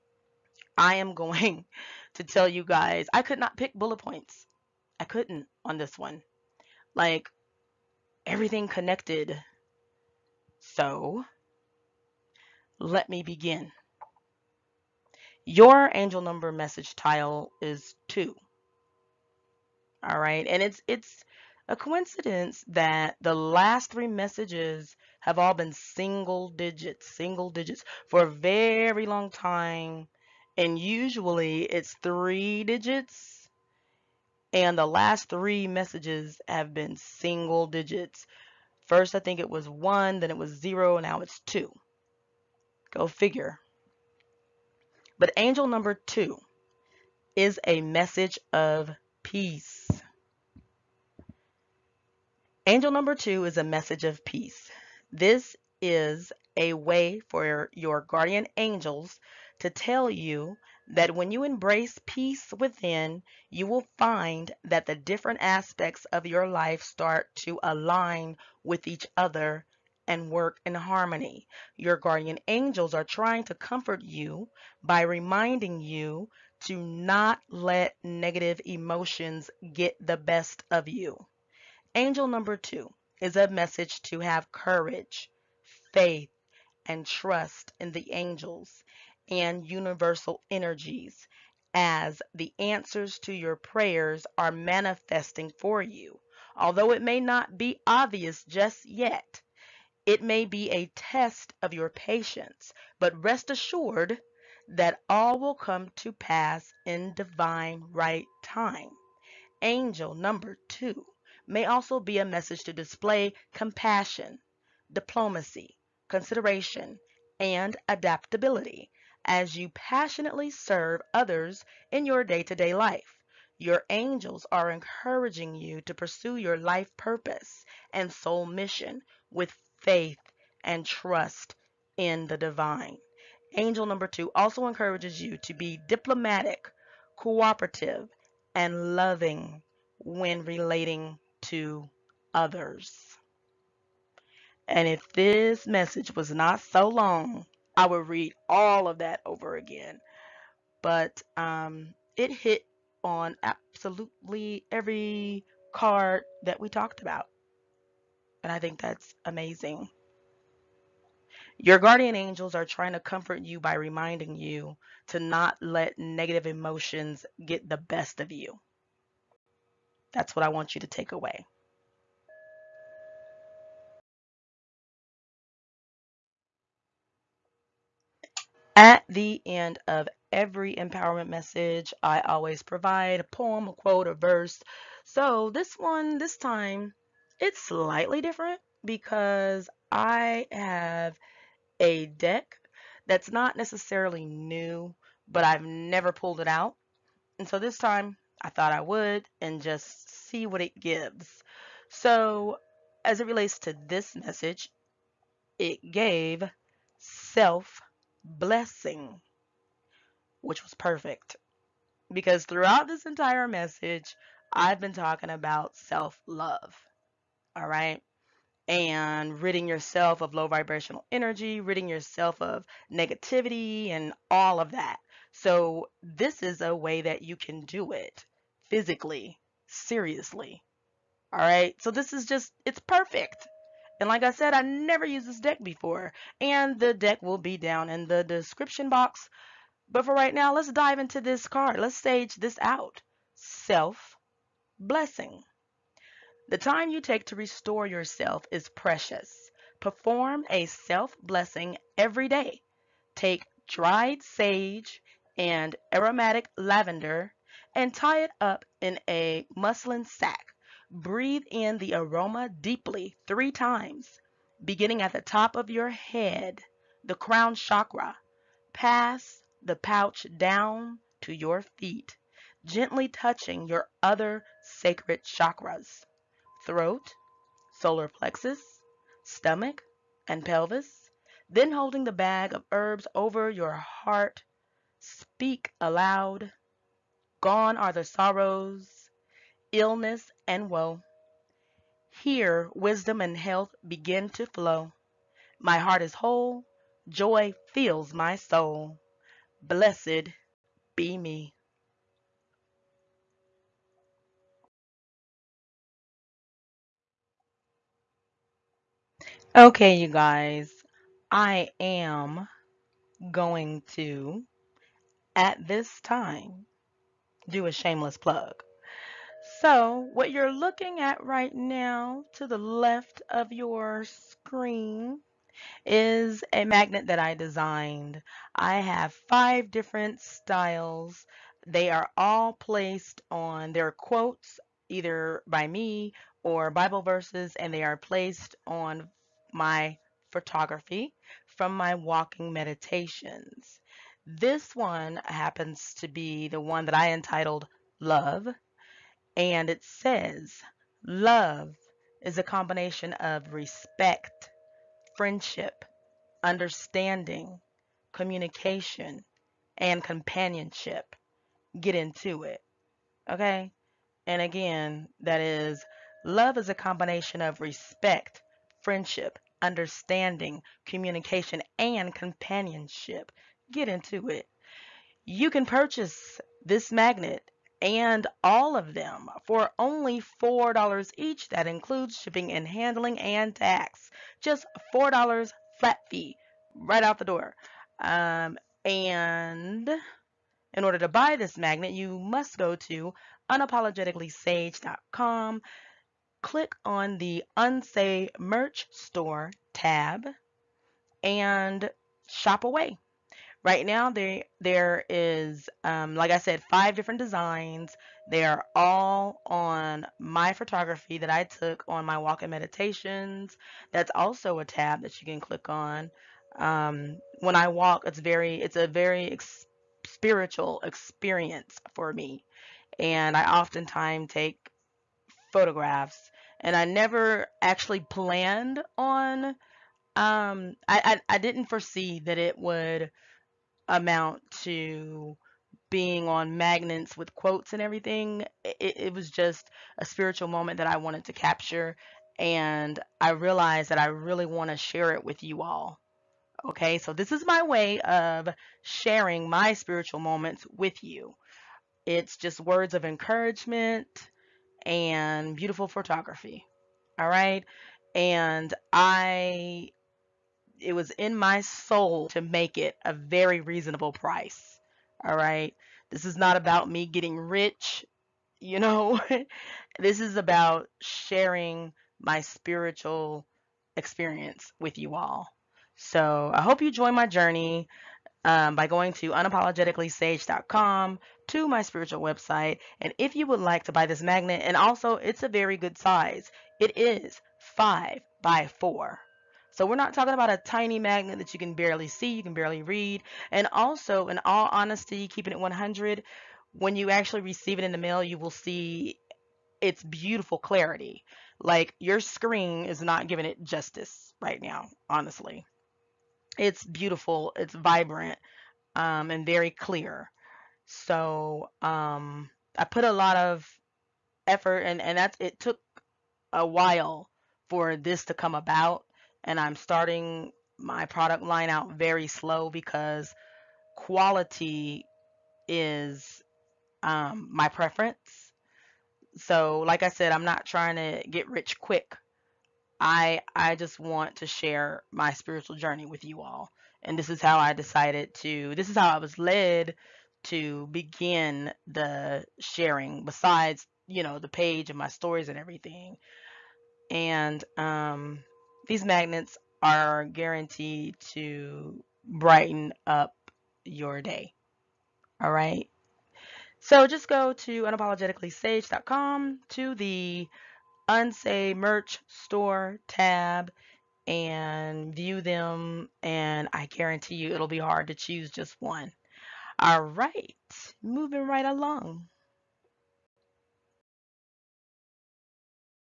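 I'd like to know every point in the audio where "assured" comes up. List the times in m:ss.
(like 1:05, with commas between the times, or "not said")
1:43.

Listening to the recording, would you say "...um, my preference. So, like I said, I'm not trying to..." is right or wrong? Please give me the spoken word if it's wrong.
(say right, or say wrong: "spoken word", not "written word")
right.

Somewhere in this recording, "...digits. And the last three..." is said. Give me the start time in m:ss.
0:32.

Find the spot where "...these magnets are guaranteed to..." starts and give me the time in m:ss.
9:08.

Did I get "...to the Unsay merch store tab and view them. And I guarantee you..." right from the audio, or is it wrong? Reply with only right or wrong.
right.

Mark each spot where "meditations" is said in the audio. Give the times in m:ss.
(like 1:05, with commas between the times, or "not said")
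5:42, 6:52.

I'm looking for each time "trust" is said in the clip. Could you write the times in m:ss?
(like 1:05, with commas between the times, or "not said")
1:27, 2:10.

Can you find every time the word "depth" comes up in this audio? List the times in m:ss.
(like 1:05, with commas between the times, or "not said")
not said.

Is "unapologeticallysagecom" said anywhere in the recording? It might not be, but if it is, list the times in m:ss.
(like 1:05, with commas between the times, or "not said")
6:33, 7:59, 9:17.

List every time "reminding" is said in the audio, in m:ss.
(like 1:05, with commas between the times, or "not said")
1:15, 2:43.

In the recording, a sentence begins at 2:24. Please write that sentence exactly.
And if this message was not so long, I would read all of that over again.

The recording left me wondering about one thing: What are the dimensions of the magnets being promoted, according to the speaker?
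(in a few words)
5 by 4.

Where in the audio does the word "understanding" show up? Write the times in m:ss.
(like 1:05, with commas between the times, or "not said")
5:56, 6:09.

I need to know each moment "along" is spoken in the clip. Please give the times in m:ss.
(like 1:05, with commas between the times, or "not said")
9:31.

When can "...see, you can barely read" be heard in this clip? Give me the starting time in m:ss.
8:12.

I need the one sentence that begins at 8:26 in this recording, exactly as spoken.
It's beautiful, it's vibrant, um, and very clear.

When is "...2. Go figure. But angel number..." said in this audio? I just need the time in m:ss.
0:41.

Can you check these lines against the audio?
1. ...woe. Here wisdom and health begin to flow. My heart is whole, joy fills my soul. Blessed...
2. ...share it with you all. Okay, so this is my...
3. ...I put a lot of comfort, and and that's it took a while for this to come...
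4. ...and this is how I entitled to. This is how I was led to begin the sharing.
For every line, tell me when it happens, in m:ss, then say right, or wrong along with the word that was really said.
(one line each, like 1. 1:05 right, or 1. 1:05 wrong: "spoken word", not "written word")
1. 4:50 right
2. 7:24 right
3. 8:32 wrong: "effort", not "comfort"
4. 8:57 wrong: "decided", not "entitled".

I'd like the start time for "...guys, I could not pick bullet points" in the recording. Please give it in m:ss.
0:02.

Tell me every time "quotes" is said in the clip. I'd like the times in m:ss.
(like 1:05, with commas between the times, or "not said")
3:03, 5:33, 7:17.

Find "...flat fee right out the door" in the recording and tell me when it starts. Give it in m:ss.
6:25.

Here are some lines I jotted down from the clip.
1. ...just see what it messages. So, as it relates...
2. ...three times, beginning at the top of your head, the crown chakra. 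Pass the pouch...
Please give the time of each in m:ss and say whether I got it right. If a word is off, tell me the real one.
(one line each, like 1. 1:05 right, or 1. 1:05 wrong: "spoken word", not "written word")
1. 3:19 wrong: "gives", not "messages"
2. 4:23 right.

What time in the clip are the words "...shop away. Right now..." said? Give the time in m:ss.
6:42.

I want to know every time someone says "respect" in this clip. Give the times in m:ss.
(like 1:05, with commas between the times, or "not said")
5:53, 6:07.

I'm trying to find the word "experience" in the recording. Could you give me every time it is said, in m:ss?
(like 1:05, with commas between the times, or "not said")
7:00, 7:53.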